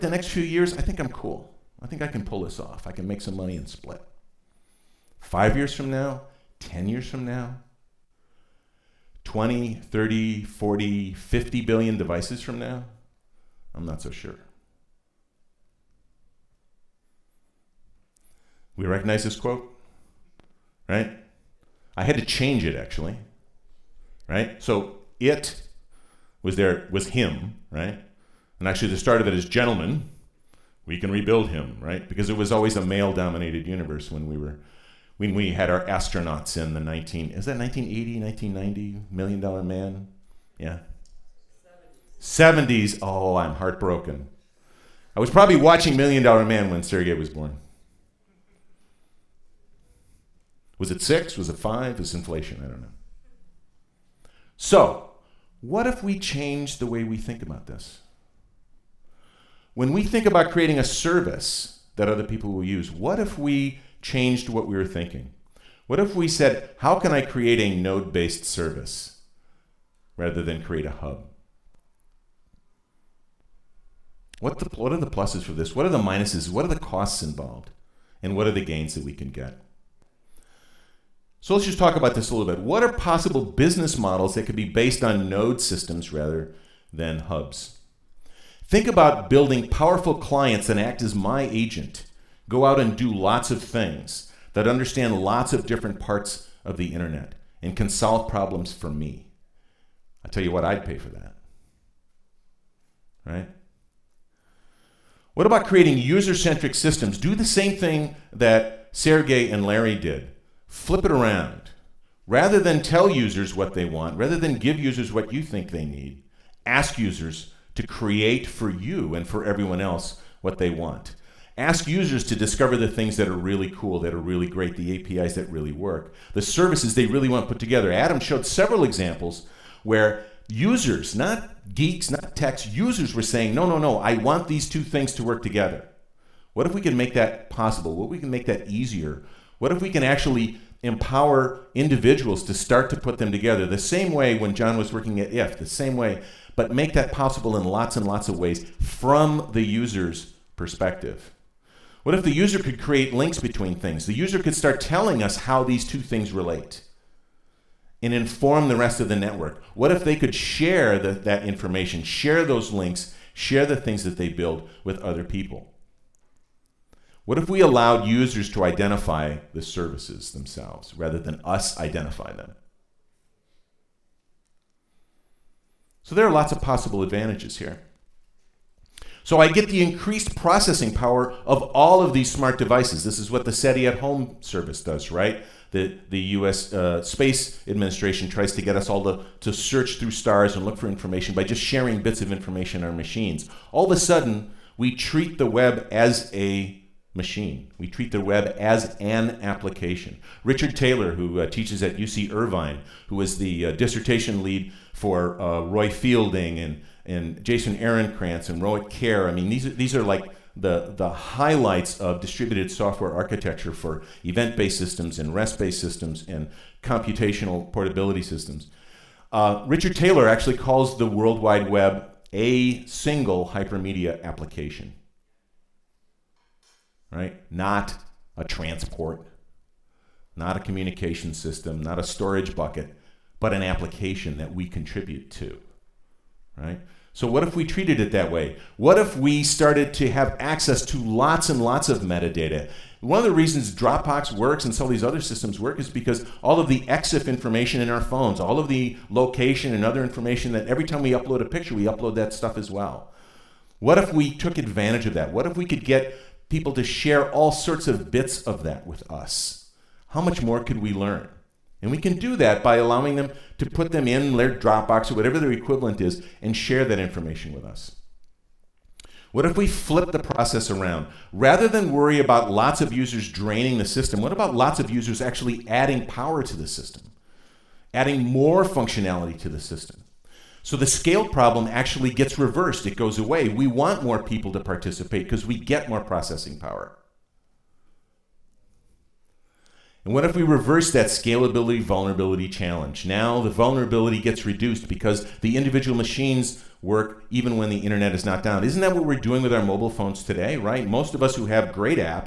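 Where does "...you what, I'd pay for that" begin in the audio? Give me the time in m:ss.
1:40.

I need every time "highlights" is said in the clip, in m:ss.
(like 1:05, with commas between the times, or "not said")
3:31.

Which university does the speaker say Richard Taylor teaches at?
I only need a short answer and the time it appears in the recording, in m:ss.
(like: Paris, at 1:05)
UC Irvine, at 3:21.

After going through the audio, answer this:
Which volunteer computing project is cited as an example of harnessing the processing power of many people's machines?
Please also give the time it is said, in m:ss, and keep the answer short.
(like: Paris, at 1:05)
SETI at home, at 3:03.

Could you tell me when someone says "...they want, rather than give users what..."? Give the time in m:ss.
1:53.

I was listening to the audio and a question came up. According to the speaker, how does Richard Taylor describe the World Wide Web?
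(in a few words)
A single hypermedia application.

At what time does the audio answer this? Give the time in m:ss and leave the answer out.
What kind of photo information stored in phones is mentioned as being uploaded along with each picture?
4:06.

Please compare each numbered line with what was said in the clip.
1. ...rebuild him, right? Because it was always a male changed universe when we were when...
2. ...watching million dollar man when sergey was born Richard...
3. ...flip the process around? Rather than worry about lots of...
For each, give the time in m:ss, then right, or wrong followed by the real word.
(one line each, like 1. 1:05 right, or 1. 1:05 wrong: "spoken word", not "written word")
1. 0:31 wrong: "dominated", not "changed"
2. 0:45 wrong: "Was", not "Richard"
3. 4:29 right.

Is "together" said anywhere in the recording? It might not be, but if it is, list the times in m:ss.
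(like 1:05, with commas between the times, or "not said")
2:07, 2:15, 2:23.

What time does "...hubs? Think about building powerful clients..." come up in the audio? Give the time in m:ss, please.
1:27.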